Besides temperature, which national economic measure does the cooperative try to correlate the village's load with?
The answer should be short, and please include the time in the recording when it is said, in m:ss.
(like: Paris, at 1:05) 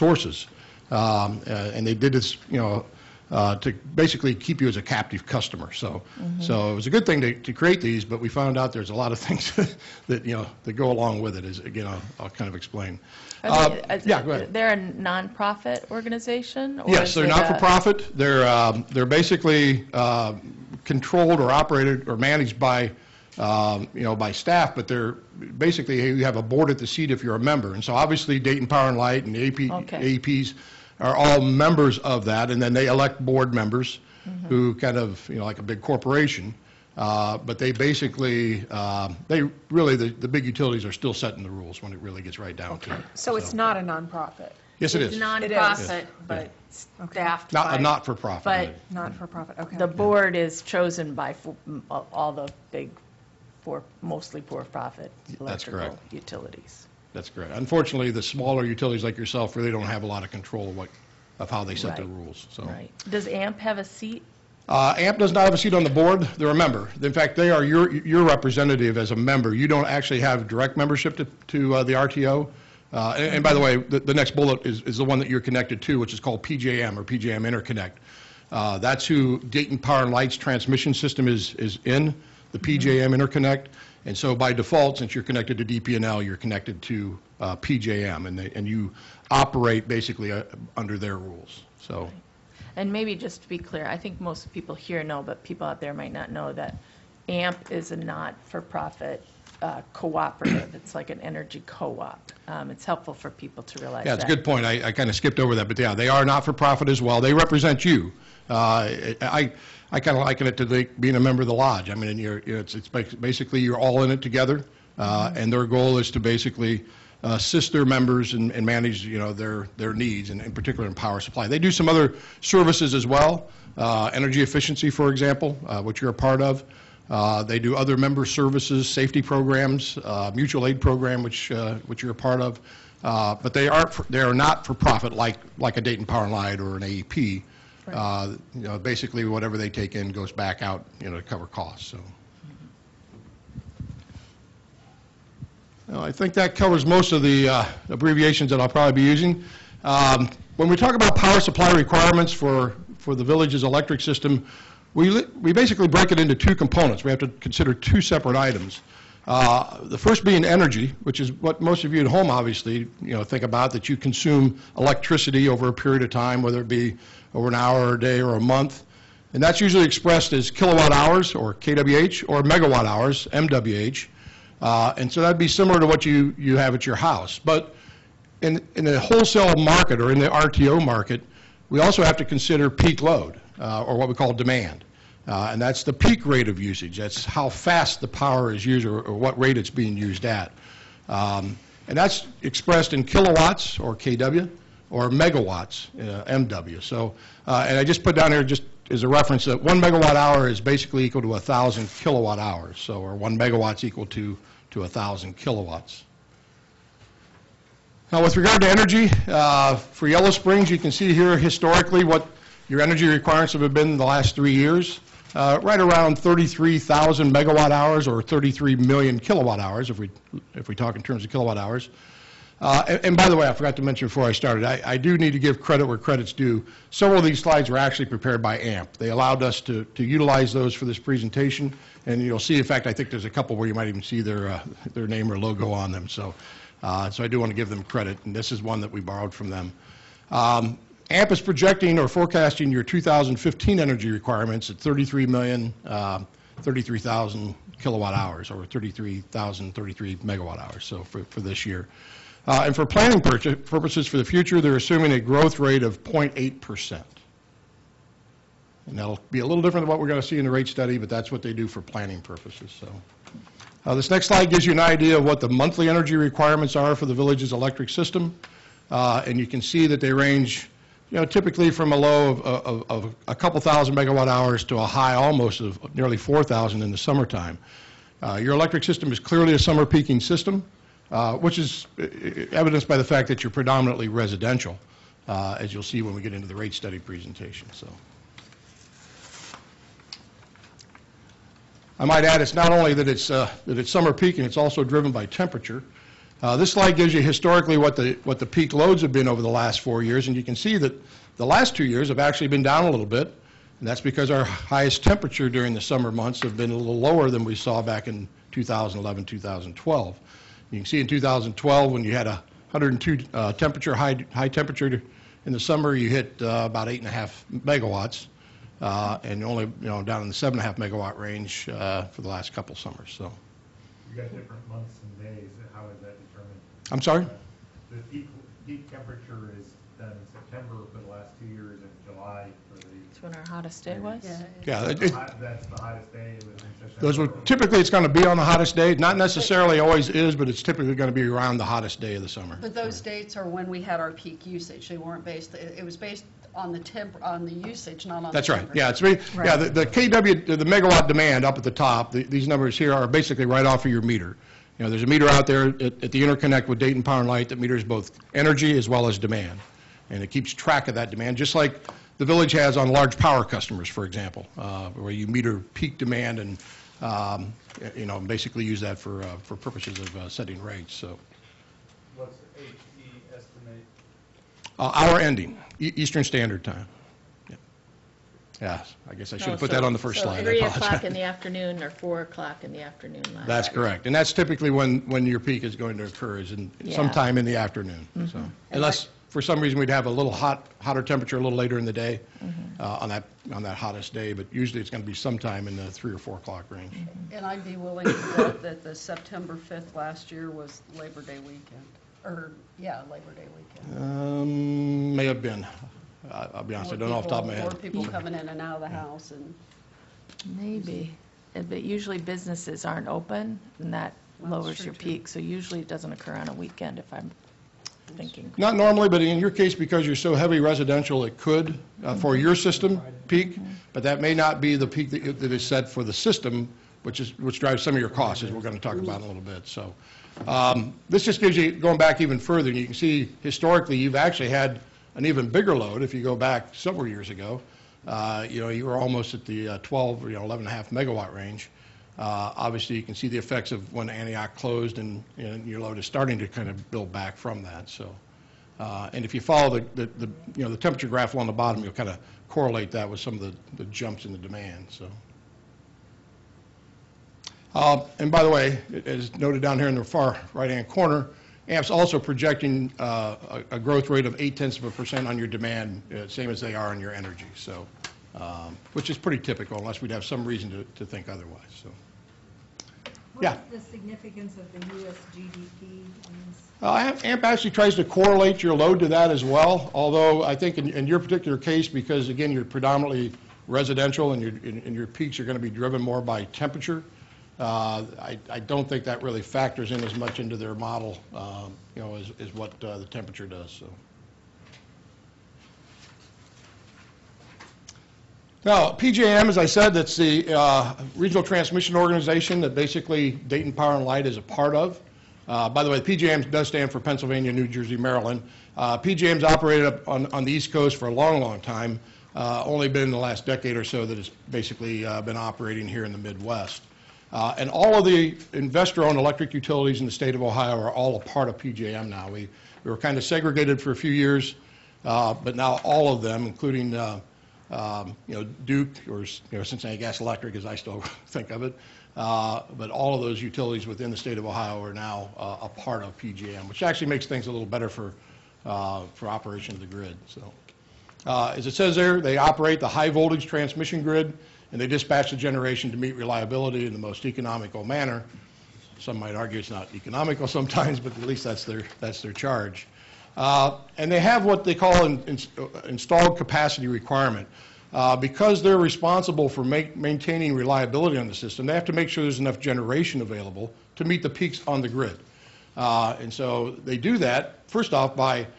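U.S. GDP, at 7:54.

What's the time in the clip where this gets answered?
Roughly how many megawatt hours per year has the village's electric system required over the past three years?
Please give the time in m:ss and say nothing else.
3:36.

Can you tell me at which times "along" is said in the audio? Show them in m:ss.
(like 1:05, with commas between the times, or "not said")
0:10, 7:31.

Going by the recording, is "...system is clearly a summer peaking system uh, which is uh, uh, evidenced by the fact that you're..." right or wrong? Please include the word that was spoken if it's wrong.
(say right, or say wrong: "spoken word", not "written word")
right.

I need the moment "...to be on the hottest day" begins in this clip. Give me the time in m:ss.
5:38.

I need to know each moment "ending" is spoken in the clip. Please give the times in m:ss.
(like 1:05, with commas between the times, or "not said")
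6:15.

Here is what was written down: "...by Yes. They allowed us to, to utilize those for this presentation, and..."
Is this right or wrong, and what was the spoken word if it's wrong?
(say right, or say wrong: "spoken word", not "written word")
wrong: "AMP", not "Yes".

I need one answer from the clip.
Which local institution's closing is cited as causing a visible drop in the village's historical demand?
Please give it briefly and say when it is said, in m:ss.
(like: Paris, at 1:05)
Antioch, at 7:24.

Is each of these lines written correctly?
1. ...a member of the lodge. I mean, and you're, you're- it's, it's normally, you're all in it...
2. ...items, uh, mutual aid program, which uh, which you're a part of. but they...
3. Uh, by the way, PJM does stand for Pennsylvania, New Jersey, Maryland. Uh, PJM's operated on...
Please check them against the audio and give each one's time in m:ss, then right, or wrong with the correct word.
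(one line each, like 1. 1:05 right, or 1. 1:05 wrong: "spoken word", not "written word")
1. 1:51 wrong: "basically", not "normally"
2. 2:09 wrong: "programs", not "items"
3. 8:25 right.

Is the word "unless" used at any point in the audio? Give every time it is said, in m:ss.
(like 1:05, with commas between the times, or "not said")
6:28, 7:49.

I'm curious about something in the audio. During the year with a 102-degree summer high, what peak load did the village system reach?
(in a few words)
8.5 megawatts.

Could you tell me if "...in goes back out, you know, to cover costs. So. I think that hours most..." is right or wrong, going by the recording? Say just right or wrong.
wrong.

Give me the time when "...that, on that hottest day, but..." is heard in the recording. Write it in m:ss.
6:33.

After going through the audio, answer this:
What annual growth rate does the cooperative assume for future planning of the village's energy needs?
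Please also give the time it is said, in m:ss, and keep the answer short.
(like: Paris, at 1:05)
0.8%, at 4:16.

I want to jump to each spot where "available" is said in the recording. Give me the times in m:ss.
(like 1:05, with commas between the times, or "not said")
9:23.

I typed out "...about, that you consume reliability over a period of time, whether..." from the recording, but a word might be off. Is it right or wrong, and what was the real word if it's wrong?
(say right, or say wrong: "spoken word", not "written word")
wrong: "electricity", not "reliability".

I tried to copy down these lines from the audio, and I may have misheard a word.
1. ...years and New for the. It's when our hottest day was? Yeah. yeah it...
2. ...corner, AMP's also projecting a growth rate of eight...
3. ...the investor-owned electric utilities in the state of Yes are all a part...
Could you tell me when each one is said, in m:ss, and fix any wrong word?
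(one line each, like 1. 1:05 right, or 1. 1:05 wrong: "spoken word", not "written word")
1. 5:31 wrong: "July", not "New"
2. 7:40 right
3. 8:38 wrong: "Ohio", not "Yes".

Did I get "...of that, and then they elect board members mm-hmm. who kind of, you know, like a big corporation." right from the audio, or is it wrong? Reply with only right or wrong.
right.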